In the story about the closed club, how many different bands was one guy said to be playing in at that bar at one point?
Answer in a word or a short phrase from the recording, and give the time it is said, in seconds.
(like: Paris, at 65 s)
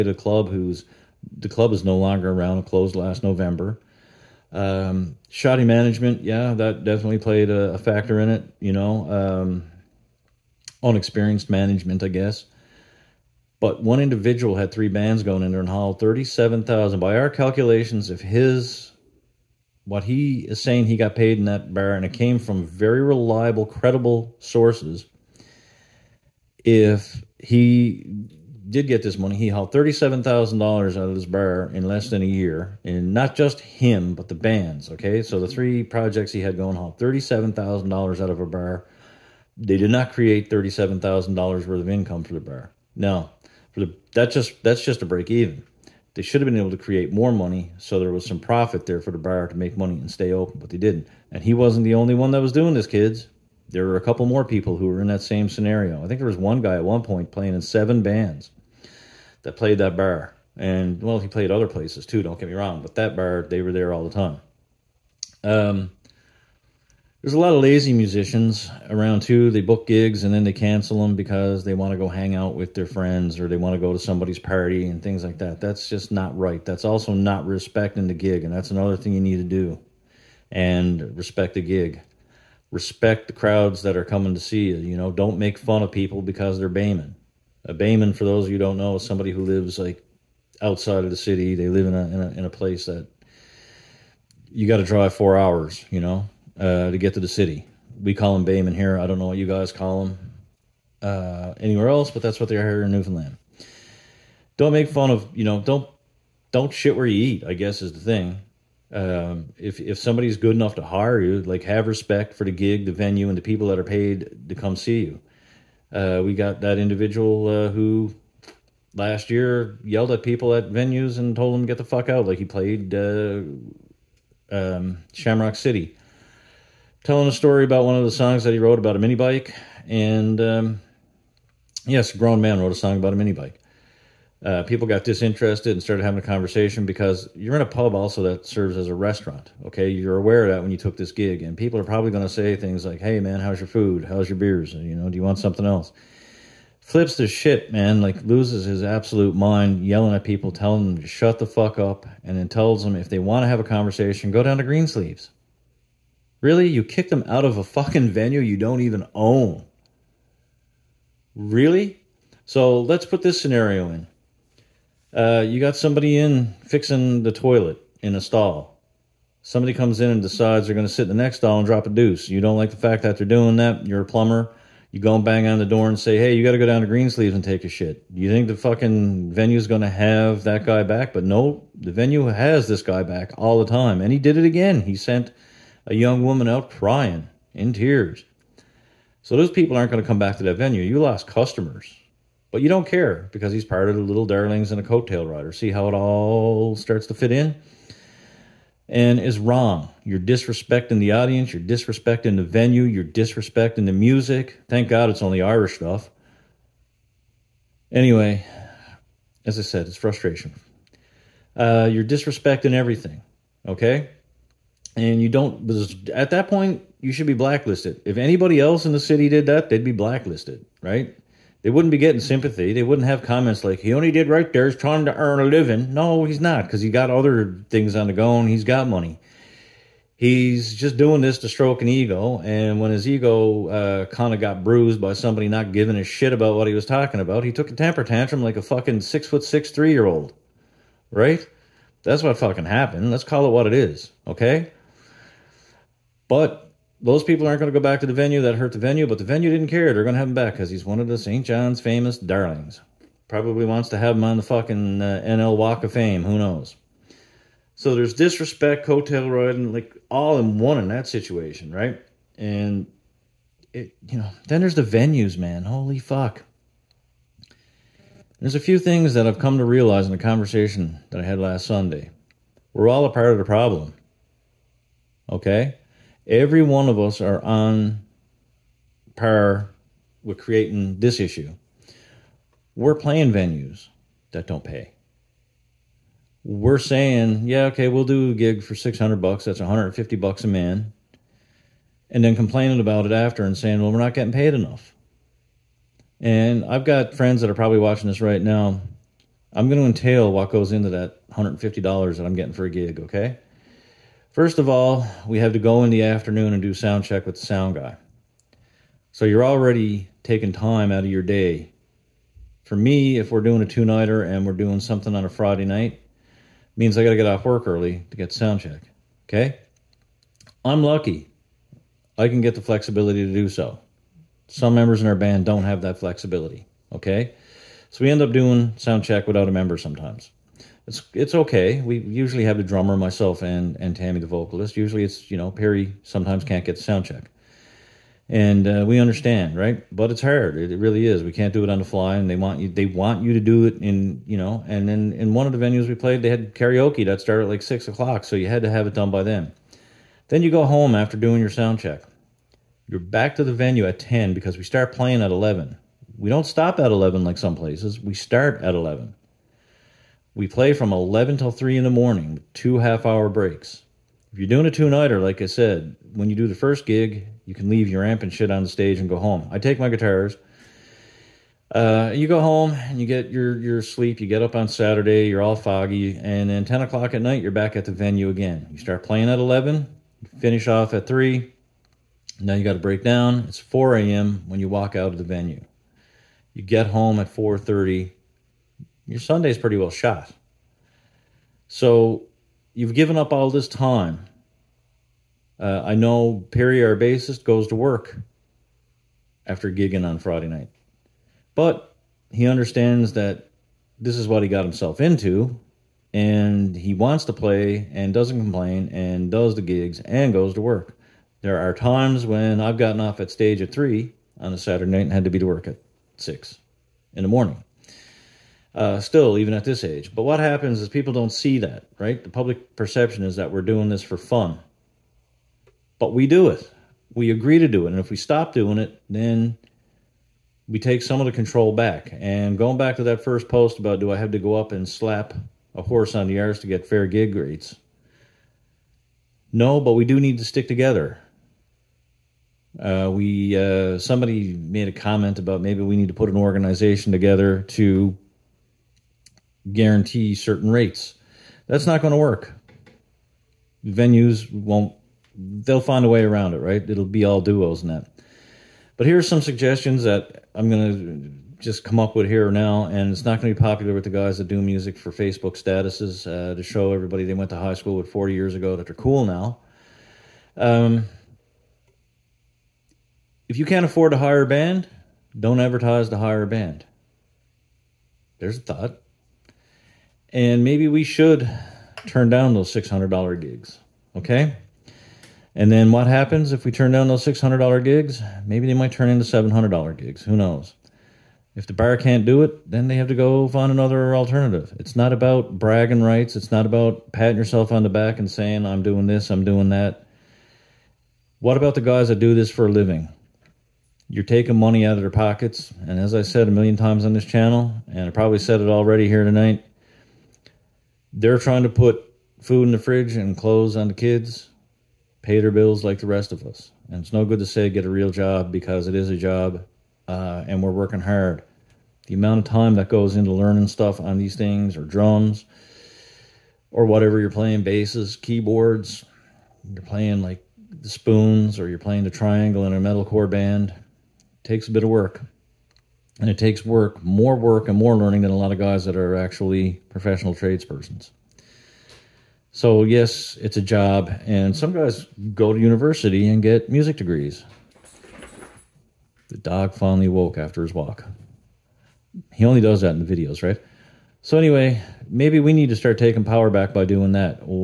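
7, at 57 s.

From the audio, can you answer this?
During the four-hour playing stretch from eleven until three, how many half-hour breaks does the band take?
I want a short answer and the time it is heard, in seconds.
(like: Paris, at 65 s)
2, at 362 s.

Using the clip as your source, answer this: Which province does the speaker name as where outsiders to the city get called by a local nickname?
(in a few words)
Newfoundland.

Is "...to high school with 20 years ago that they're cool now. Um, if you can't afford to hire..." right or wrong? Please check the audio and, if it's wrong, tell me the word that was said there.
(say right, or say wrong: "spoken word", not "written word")
wrong: "40", not "20".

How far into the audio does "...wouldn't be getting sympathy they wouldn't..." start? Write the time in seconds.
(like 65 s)
221 s.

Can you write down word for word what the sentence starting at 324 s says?
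Some members in our band don't have that flexibility.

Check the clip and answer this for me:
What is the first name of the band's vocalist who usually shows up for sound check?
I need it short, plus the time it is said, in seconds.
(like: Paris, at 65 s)
Tammy, at 333 s.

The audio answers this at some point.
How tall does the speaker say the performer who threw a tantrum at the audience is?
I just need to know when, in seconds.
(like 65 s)
238 s.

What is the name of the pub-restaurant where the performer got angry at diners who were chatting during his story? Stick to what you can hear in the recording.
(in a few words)
Shamrock City.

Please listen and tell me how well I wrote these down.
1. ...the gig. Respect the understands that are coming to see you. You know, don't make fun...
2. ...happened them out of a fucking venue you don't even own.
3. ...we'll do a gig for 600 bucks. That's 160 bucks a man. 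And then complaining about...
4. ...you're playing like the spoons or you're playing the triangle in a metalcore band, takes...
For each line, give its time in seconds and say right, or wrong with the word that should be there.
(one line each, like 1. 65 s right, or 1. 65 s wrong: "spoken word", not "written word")
1. 81 s wrong: "crowds", not "understands"
2. 156 s wrong: "kicked", not "happened"
3. 287 s wrong: "150", not "160"
4. 529 s right.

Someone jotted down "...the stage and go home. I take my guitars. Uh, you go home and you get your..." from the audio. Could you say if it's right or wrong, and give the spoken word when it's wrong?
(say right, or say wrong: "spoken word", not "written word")
right.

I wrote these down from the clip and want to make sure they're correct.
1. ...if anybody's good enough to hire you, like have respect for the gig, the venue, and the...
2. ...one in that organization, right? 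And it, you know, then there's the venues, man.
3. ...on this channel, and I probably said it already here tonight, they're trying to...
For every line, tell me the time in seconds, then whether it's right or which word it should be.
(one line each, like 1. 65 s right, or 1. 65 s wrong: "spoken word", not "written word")
1. 109 s wrong: "somebody", not "anybody"
2. 260 s wrong: "situation", not "organization"
3. 507 s right.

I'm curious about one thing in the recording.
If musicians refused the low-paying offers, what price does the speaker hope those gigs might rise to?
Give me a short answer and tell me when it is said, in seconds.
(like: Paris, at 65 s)
$700, at 489 s.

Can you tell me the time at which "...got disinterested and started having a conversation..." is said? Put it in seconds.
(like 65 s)
134 s.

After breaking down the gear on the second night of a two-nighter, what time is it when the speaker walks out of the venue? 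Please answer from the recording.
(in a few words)
4 a.m.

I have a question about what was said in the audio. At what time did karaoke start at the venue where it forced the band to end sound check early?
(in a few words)
6 o'clock.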